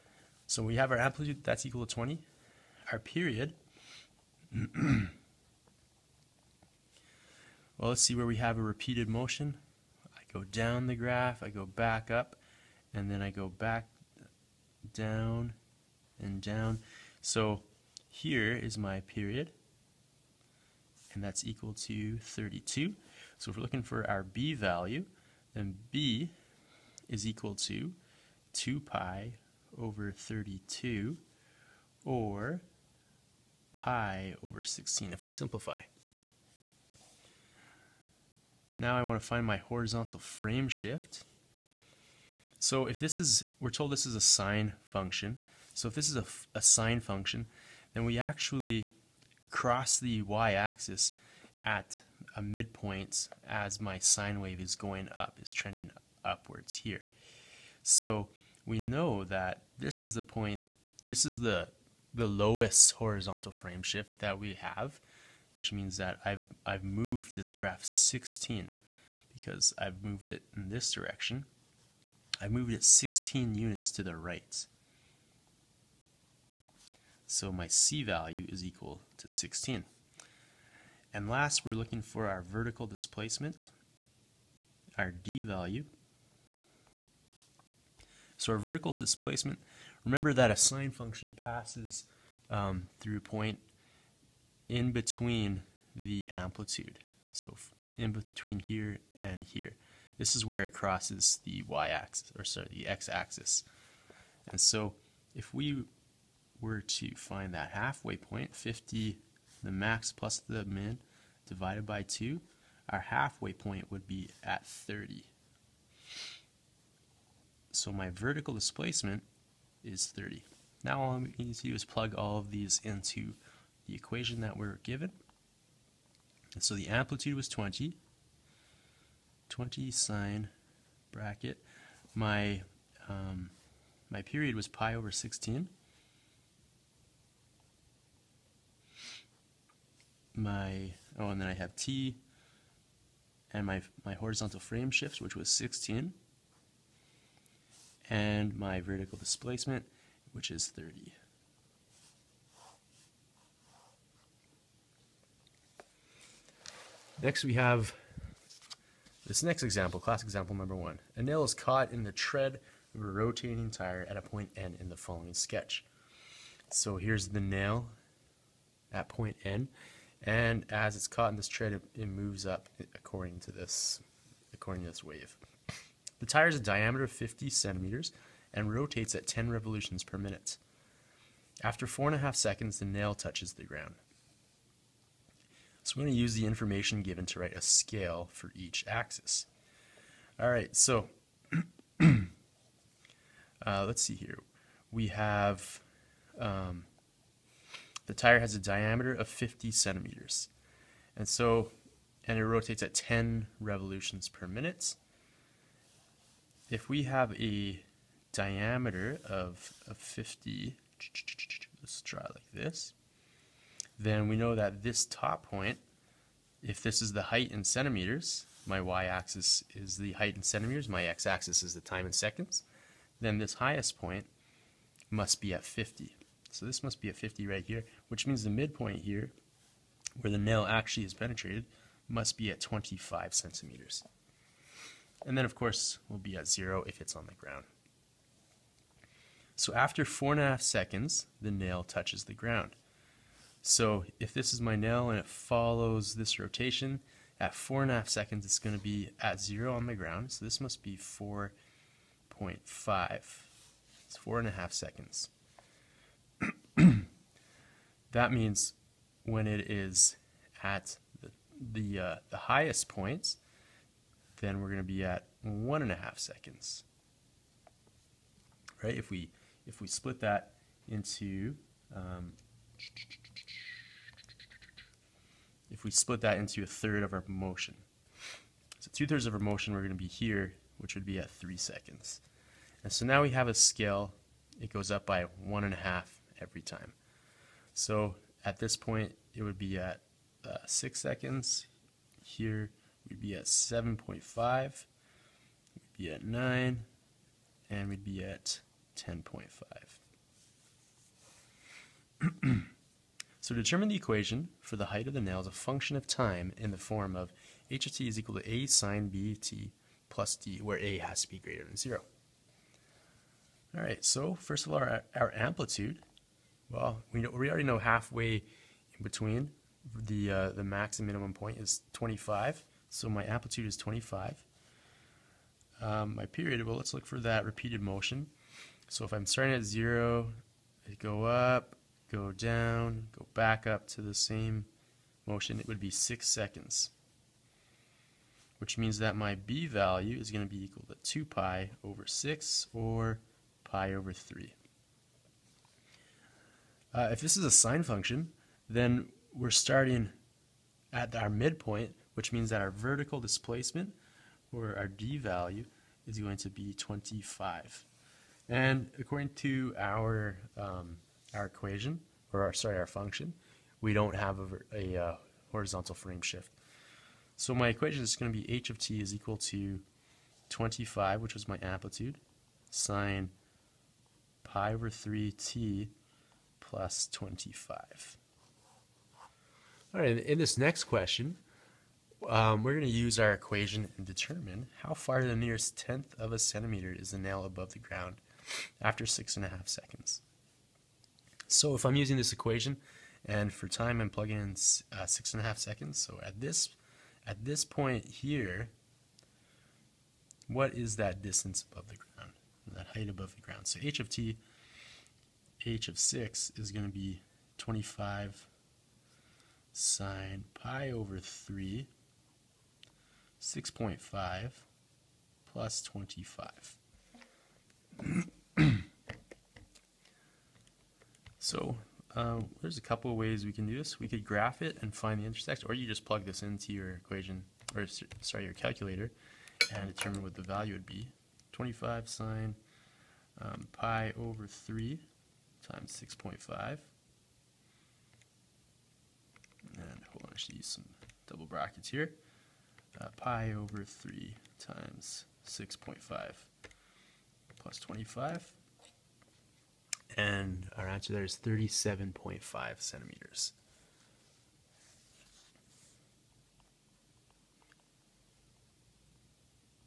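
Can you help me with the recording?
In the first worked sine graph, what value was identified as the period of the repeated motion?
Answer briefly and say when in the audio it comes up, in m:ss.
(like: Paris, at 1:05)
32, at 0:21.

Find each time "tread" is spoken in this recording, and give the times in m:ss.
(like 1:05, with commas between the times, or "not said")
2:42, 2:51.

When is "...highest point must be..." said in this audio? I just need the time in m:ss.
3:43.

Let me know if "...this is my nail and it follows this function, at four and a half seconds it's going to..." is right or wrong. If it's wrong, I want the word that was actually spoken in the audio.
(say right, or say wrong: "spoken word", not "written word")
wrong: "rotation", not "function".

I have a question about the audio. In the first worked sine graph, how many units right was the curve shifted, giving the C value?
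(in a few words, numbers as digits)
16.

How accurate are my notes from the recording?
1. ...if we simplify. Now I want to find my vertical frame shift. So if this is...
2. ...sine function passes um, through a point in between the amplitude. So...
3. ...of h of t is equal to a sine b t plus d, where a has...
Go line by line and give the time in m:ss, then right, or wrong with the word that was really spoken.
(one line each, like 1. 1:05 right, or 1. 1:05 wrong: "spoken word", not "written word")
1. 0:35 wrong: "horizontal", not "vertical"
2. 1:30 right
3. 5:07 right.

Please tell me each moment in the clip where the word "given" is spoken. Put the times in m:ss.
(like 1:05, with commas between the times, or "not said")
2:04, 3:07.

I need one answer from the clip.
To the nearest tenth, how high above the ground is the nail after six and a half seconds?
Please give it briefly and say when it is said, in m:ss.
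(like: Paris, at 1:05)
37.5 centimeters, at 7:31.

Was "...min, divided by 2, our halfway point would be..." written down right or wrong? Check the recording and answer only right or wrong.
right.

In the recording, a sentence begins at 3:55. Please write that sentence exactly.
And then of course we'll be at zero if it's on the ground.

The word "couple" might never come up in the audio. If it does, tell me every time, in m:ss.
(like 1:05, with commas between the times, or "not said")
7:02.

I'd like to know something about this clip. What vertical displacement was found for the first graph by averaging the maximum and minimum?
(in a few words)
30.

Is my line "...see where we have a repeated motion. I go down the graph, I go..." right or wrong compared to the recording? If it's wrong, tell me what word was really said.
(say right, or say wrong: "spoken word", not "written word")
right.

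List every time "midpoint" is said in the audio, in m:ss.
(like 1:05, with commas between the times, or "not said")
0:52, 3:48, 5:51.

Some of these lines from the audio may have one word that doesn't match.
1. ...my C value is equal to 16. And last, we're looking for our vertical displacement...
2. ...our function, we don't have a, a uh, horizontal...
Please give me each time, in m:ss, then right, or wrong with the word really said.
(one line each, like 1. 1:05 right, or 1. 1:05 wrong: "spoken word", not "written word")
1. 1:17 right
2. 6:02 right.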